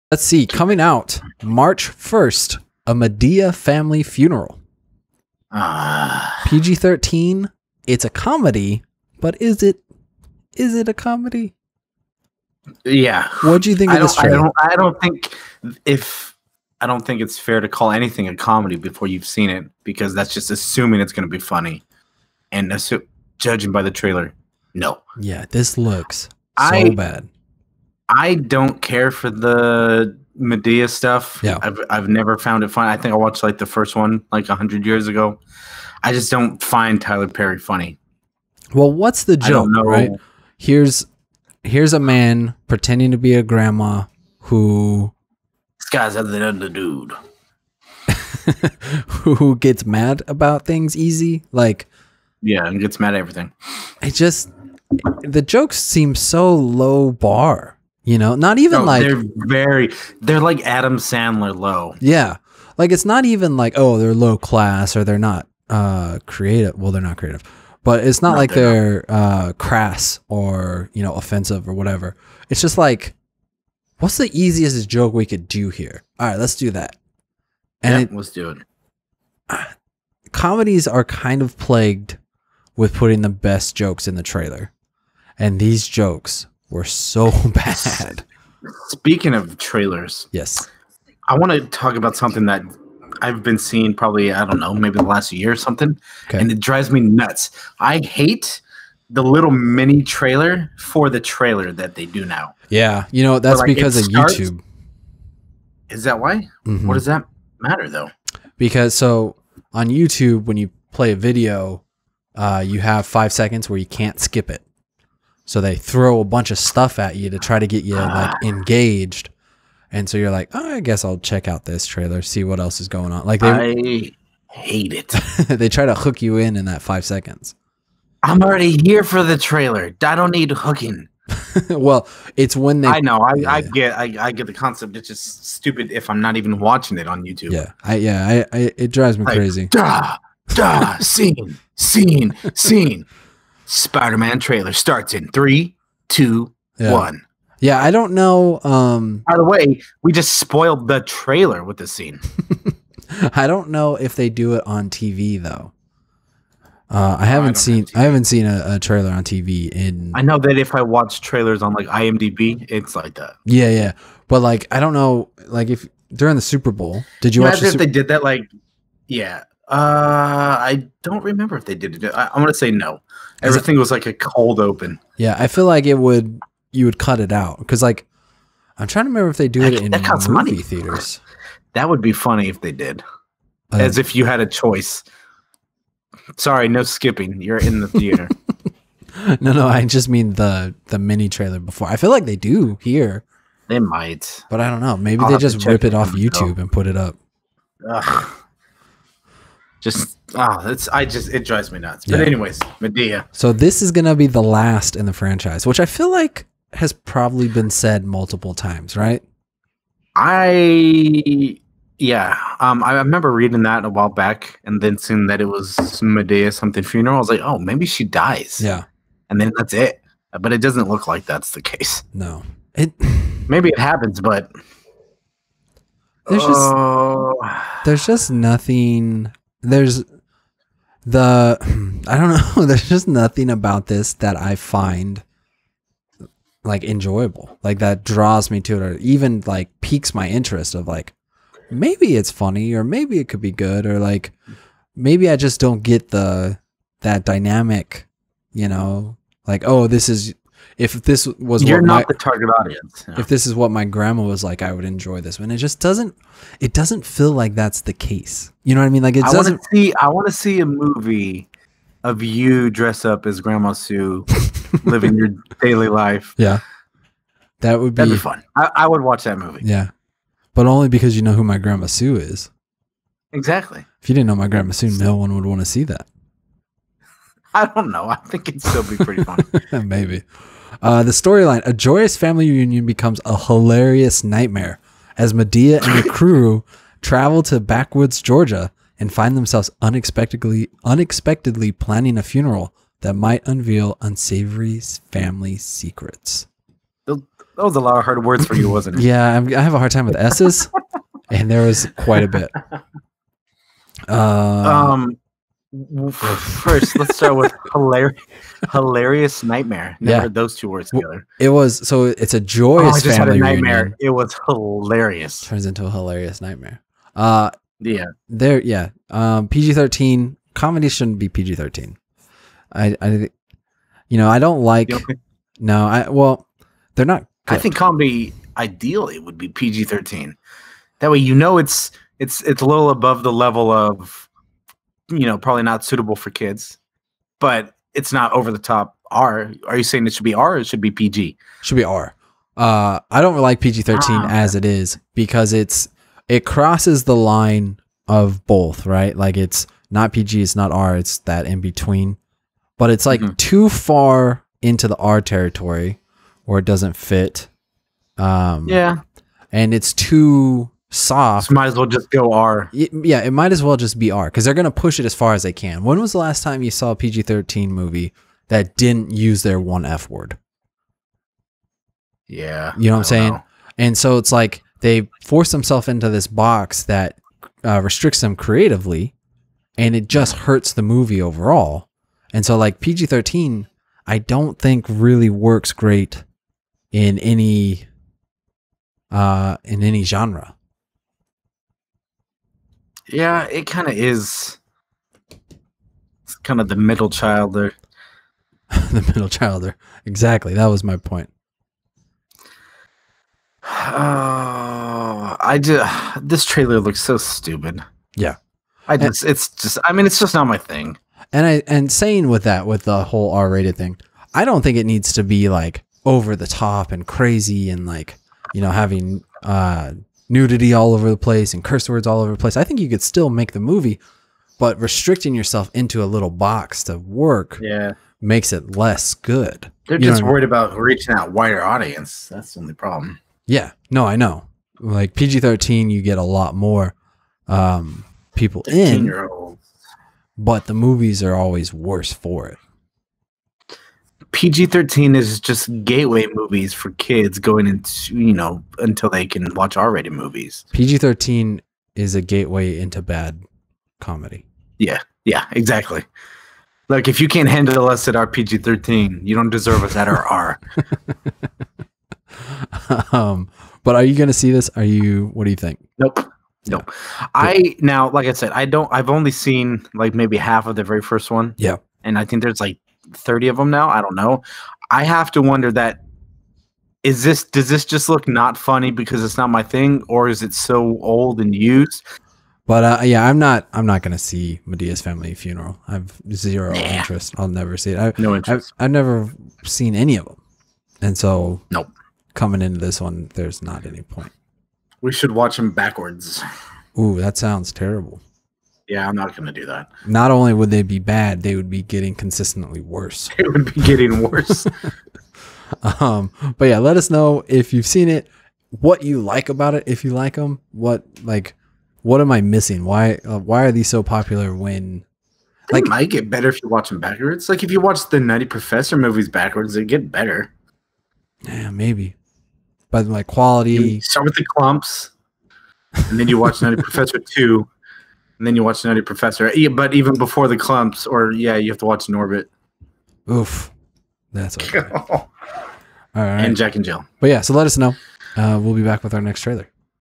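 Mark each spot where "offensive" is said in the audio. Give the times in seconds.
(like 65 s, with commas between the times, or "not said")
71 s.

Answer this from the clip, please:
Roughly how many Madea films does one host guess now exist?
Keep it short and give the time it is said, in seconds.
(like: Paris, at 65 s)
30, at 473 s.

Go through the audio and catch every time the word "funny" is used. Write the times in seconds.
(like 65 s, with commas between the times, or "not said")
21 s, 37 s, 182 s, 242 s, 279 s, 478 s.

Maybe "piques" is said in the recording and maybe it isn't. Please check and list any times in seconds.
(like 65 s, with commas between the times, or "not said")
239 s.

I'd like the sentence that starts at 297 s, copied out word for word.
That was a lot of hard words for you, wasn't it?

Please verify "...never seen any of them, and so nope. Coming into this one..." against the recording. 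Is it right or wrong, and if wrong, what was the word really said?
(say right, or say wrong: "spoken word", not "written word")
right.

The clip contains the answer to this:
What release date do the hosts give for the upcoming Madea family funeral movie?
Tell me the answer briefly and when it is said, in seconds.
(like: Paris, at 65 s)
March 1st, at 1 s.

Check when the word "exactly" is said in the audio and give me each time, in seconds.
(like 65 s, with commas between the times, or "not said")
273 s, 400 s, 455 s.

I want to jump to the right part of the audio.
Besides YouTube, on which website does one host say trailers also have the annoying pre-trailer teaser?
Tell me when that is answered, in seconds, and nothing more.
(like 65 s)
161 s.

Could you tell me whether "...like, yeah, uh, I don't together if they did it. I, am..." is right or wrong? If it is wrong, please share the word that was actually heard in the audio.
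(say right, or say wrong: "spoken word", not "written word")
wrong: "remember", not "together".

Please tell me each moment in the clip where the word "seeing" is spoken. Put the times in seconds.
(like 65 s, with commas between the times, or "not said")
93 s, 214 s.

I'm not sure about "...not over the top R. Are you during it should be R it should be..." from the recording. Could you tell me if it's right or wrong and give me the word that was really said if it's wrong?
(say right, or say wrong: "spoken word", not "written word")
wrong: "saying", not "during".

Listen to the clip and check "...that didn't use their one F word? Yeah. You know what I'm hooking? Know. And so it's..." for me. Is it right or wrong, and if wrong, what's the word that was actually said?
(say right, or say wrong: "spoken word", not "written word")
wrong: "saying", not "hooking".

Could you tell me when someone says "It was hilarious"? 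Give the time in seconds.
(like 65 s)
314 s.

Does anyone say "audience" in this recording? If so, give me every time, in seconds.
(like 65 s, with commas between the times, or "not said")
252 s, 431 s.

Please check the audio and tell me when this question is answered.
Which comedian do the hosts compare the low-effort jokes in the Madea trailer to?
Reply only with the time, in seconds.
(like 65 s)
60 s.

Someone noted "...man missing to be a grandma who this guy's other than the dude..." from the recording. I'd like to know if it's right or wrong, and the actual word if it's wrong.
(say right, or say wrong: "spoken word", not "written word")
wrong: "pretending", not "missing".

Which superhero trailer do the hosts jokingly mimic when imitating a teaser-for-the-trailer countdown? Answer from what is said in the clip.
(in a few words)
Spider-Man.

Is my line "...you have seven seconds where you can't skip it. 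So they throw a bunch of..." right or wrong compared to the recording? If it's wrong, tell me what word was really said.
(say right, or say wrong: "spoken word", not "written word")
wrong: "five", not "seven".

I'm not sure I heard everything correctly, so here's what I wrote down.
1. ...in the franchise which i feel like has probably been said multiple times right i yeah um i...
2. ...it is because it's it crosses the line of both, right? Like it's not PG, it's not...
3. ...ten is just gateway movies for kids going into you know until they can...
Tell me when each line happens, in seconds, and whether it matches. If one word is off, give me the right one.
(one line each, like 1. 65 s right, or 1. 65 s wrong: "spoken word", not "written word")
1. 204 s right
2. 344 s right
3. 444 s wrong: "thirteen", not "ten".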